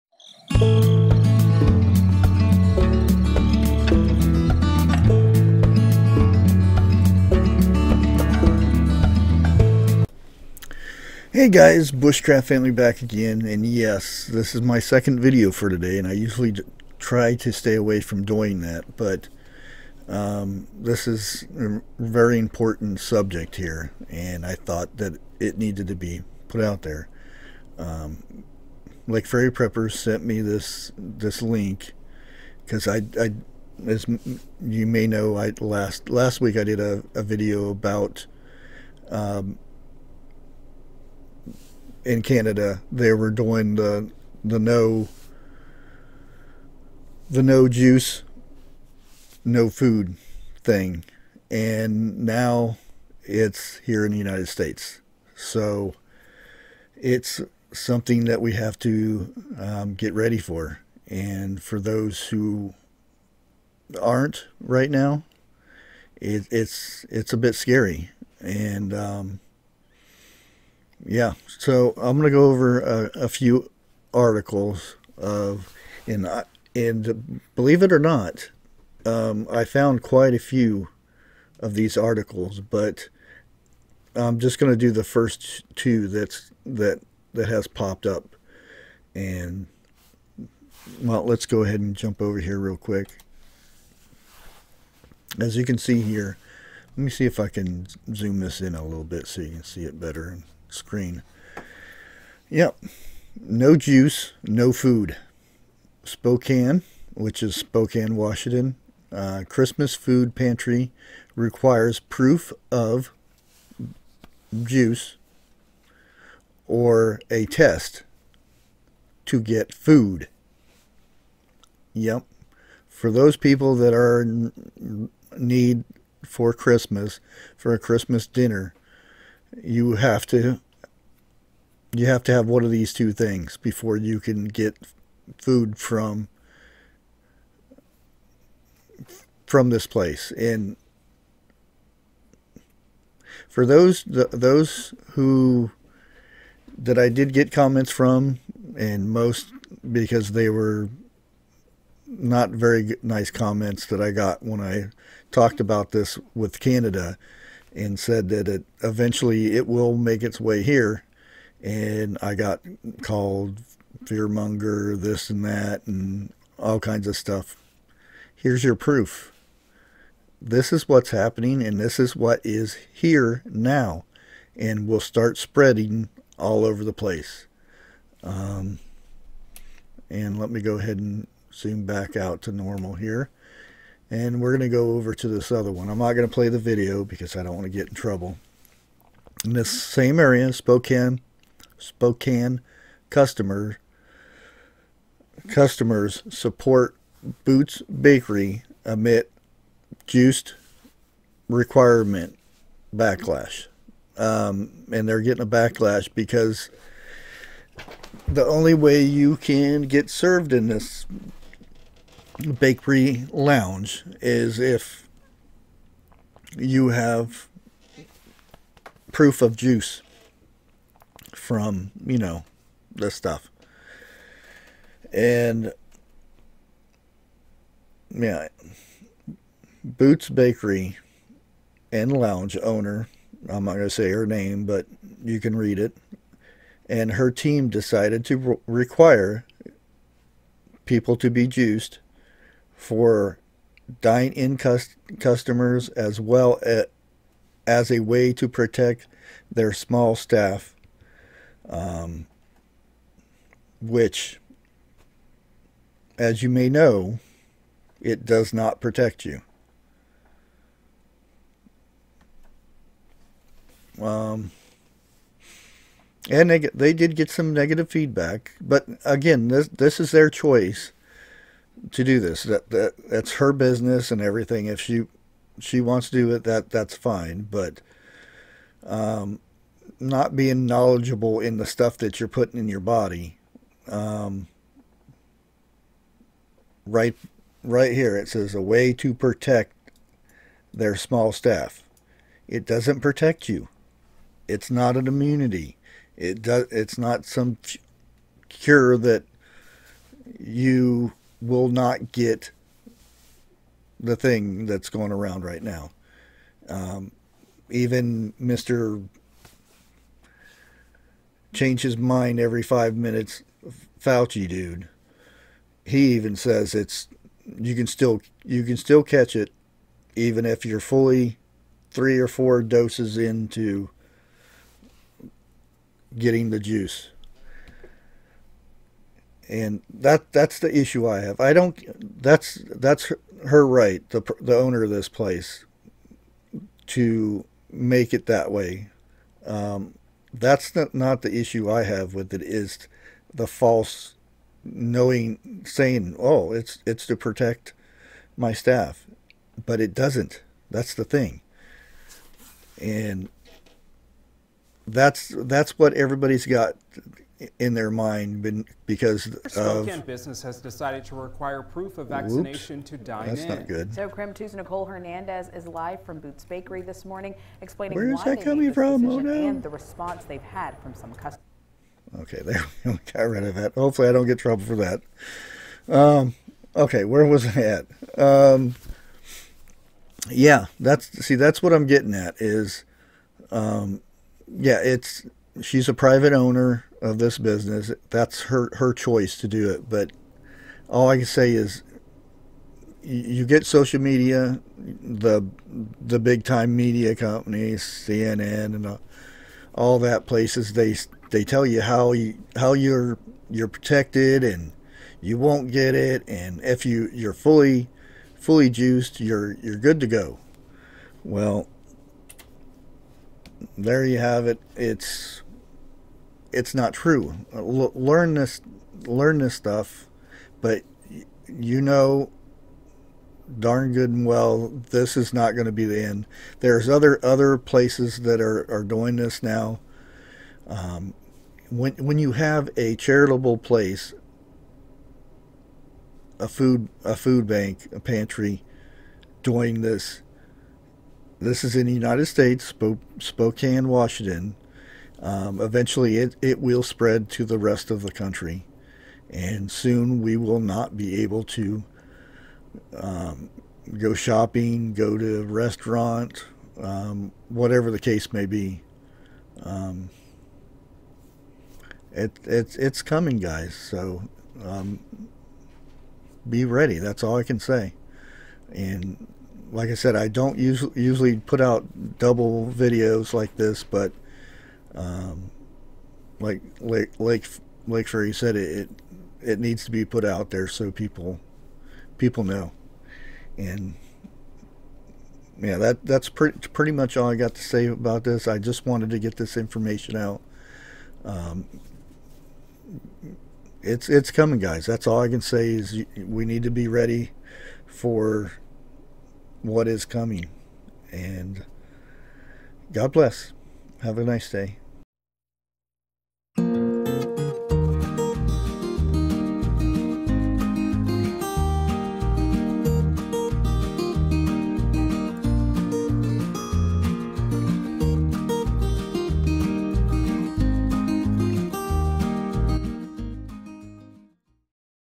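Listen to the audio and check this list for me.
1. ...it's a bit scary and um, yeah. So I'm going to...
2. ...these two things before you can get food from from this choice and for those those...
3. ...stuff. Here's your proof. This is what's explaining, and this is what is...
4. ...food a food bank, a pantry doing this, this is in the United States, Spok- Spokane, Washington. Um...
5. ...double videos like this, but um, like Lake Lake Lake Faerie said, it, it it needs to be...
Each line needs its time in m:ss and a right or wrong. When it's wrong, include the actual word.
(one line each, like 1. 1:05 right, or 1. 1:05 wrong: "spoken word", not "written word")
1. 1:07 right
2. 2:12 wrong: "place", not "choice"
3. 2:47 wrong: "happening", not "explaining"
4. 7:16 right
5. 7:52 right.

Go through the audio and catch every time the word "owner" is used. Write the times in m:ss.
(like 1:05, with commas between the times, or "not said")
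3:52, 5:34, 6:26.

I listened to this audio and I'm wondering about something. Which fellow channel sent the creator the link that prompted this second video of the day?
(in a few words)
Lake Faerie Preppers.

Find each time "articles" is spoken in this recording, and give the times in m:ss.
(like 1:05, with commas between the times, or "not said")
1:14, 1:21.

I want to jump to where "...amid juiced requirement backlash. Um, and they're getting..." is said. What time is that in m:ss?
3:18.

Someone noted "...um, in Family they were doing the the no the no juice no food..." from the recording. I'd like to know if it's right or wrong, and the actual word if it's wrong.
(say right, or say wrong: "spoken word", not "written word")
wrong: "Canada", not "Family".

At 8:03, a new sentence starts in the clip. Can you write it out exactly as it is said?
And yeah, that that's pretty pretty much all I got to say about this.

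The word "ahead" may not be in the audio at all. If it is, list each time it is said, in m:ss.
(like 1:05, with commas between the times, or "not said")
1:31, 3:00.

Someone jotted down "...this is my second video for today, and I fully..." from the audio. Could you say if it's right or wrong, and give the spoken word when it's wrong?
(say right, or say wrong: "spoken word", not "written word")
wrong: "usually", not "fully".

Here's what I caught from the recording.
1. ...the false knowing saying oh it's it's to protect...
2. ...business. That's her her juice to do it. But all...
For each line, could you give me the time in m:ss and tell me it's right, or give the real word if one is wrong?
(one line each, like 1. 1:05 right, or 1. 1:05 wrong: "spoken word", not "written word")
1. 5:43 right
2. 6:27 wrong: "choice", not "juice".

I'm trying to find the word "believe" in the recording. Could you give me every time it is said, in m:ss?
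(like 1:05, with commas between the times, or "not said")
1:17.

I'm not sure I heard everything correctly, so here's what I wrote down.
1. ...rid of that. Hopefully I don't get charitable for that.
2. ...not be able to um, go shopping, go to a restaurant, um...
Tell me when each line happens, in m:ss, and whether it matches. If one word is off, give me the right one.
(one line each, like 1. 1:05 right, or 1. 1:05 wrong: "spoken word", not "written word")
1. 6:13 wrong: "trouble", not "charitable"
2. 7:30 right.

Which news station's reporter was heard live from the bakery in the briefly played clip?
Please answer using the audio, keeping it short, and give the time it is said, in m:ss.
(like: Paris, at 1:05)
KREM 2, at 6:04.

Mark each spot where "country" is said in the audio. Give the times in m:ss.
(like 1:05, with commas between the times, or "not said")
7:28.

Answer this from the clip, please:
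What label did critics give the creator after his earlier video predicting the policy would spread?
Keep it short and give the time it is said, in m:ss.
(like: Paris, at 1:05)
fearmonger, at 2:44.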